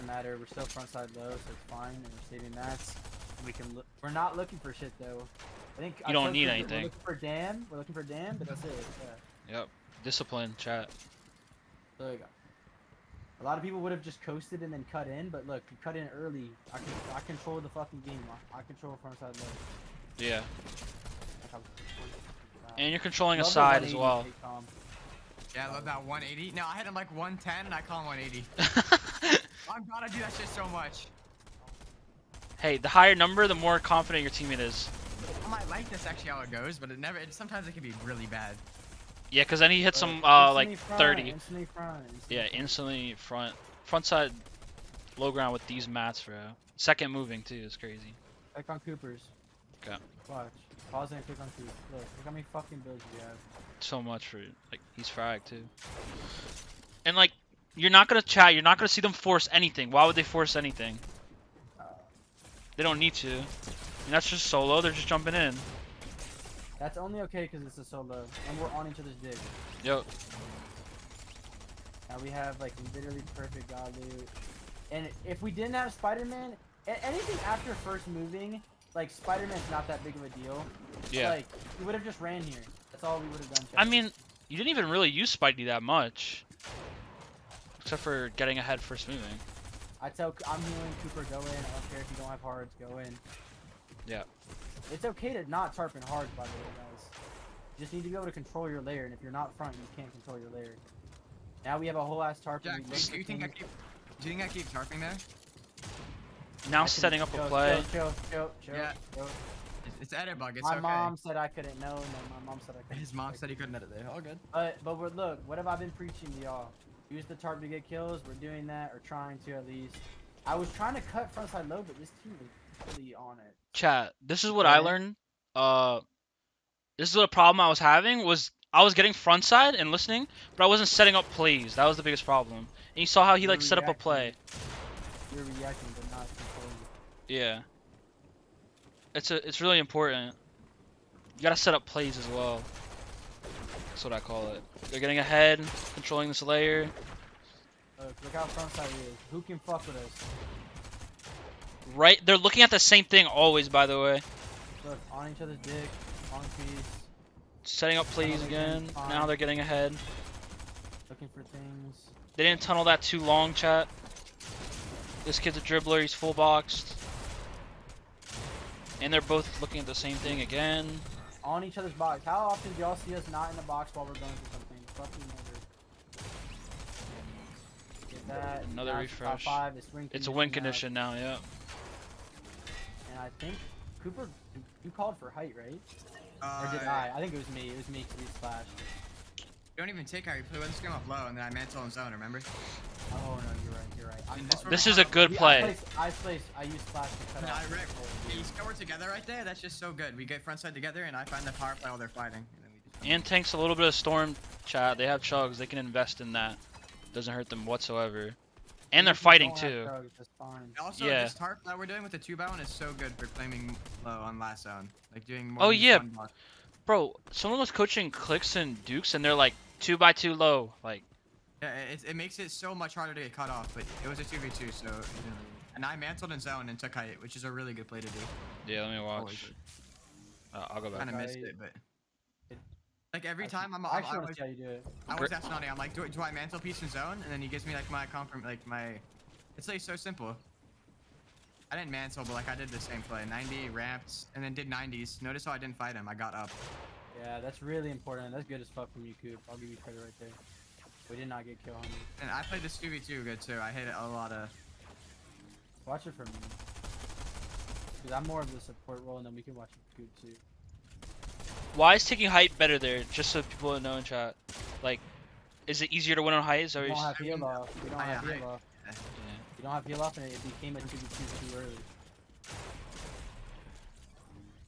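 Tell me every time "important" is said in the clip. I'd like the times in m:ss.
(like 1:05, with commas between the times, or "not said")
2:19, 4:07.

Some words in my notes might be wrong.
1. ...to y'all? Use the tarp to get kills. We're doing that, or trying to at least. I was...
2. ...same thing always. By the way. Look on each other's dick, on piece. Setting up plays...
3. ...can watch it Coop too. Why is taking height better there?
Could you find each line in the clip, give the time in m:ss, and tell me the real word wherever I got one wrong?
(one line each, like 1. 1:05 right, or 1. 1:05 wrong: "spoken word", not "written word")
1. 1:56 right
2. 2:32 right
3. 4:19 right.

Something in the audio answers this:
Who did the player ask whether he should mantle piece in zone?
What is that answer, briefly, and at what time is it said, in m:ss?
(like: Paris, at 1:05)
Nani, at 3:55.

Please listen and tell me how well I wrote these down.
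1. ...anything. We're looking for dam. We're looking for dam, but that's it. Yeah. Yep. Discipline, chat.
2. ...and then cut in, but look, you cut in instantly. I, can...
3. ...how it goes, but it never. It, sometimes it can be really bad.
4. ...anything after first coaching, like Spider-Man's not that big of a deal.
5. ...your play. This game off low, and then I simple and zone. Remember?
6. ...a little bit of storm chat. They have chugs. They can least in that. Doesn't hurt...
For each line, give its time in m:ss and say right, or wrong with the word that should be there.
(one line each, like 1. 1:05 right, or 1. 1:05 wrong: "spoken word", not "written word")
1. 0:06 right
2. 0:14 wrong: "early", not "instantly"
3. 0:36 right
4. 1:16 wrong: "moving", not "coaching"
5. 3:10 wrong: "mantle", not "simple"
6. 3:23 wrong: "invest", not "least".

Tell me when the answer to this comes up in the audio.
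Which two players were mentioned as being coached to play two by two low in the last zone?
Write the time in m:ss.
3:38.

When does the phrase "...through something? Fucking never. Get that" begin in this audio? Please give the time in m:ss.
2:54.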